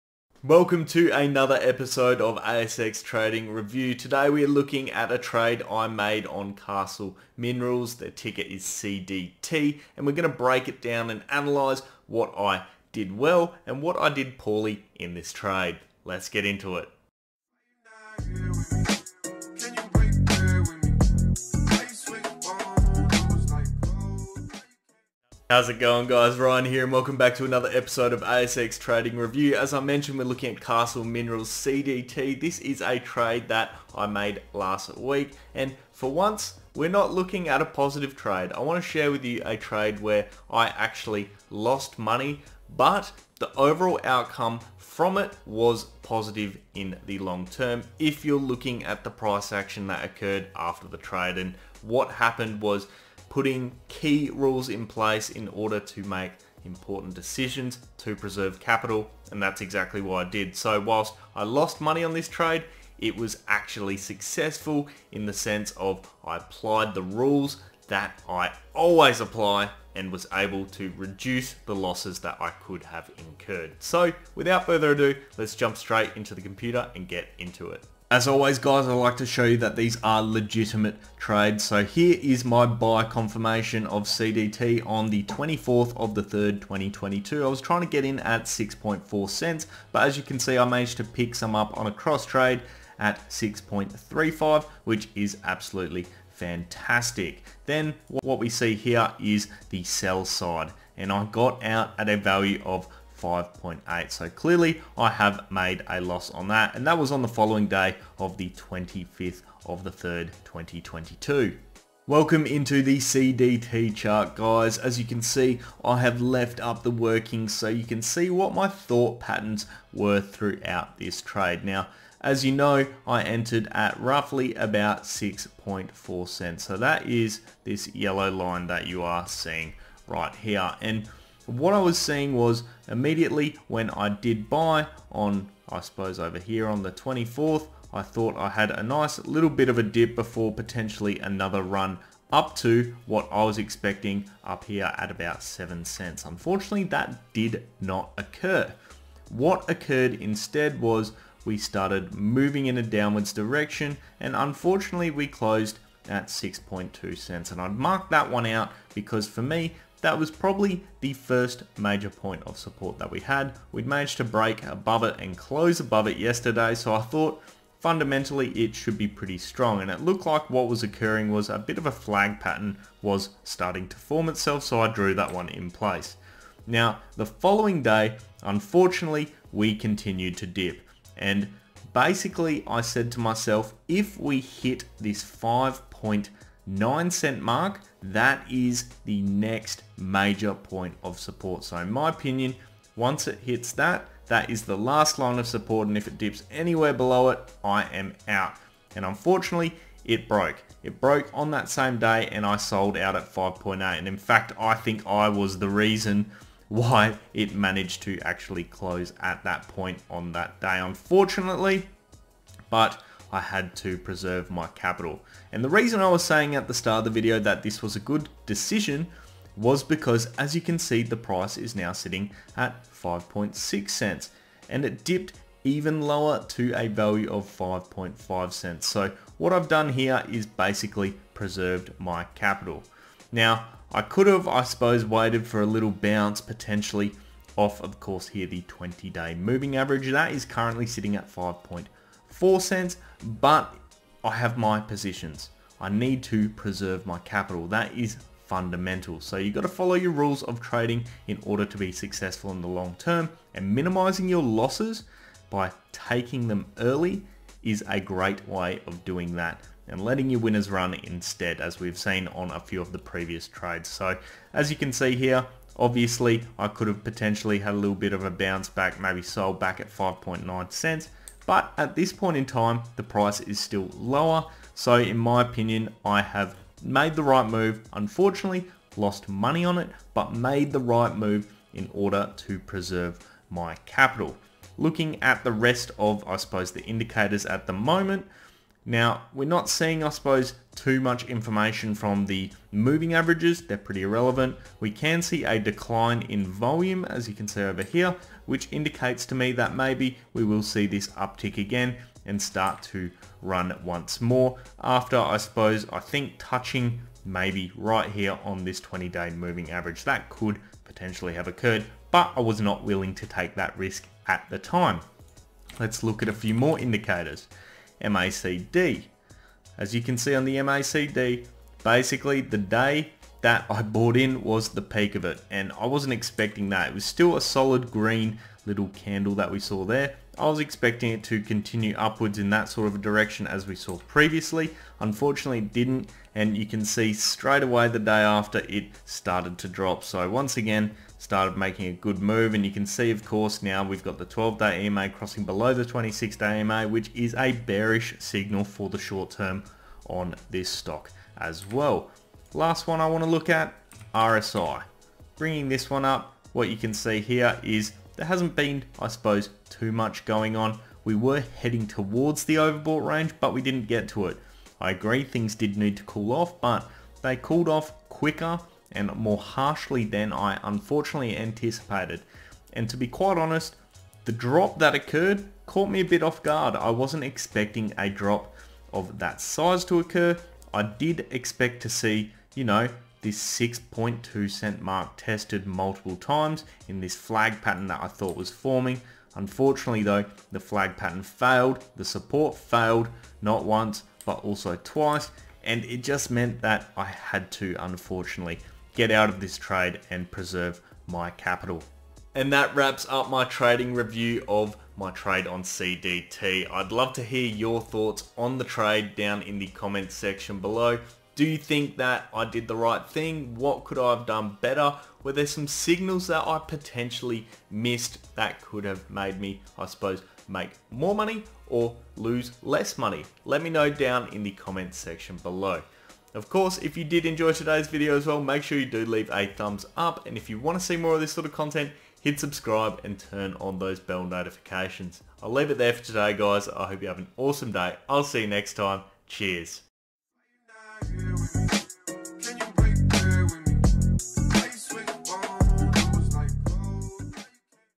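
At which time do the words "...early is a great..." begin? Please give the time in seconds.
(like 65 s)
256 s.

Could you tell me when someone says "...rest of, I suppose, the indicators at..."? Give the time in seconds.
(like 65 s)
285 s.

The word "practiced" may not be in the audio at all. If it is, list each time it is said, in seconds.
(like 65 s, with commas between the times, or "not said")
not said.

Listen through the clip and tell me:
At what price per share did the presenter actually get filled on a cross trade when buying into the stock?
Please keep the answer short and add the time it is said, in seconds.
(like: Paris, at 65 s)
6.35 cents, at 93 s.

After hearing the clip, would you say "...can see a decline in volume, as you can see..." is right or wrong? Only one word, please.
right.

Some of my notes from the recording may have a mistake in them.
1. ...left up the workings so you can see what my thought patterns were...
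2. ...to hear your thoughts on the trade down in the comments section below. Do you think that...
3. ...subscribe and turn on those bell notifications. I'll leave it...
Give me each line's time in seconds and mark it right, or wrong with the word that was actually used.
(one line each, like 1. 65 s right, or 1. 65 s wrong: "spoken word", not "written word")
1. 116 s right
2. 407 s right
3. 432 s right.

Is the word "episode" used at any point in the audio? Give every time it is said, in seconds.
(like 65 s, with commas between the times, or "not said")
1 s, 27 s.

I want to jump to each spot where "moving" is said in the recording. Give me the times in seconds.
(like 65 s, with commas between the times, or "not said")
152 s, 239 s, 292 s, 309 s.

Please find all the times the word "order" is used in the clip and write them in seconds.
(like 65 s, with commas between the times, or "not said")
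55 s, 251 s, 281 s.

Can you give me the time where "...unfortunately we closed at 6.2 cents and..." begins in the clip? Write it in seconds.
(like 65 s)
154 s.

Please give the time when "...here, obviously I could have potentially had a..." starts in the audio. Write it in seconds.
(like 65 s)
265 s.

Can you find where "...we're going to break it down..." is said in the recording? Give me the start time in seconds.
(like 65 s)
10 s.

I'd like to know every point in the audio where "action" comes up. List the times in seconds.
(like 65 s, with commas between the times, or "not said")
49 s.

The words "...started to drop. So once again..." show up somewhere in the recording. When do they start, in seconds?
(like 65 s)
339 s.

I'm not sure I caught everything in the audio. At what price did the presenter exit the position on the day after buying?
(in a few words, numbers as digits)
5.8 cents.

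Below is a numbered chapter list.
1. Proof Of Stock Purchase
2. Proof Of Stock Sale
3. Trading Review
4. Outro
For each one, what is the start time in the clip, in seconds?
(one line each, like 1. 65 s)
1. 65 s
2. 78 s
3. 111 s
4. 402 s.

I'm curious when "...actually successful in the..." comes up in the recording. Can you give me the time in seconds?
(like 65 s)
63 s.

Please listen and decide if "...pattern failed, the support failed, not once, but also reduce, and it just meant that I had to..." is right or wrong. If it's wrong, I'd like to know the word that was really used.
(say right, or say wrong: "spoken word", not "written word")
wrong: "twice", not "reduce".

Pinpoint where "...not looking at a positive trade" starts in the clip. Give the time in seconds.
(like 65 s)
36 s.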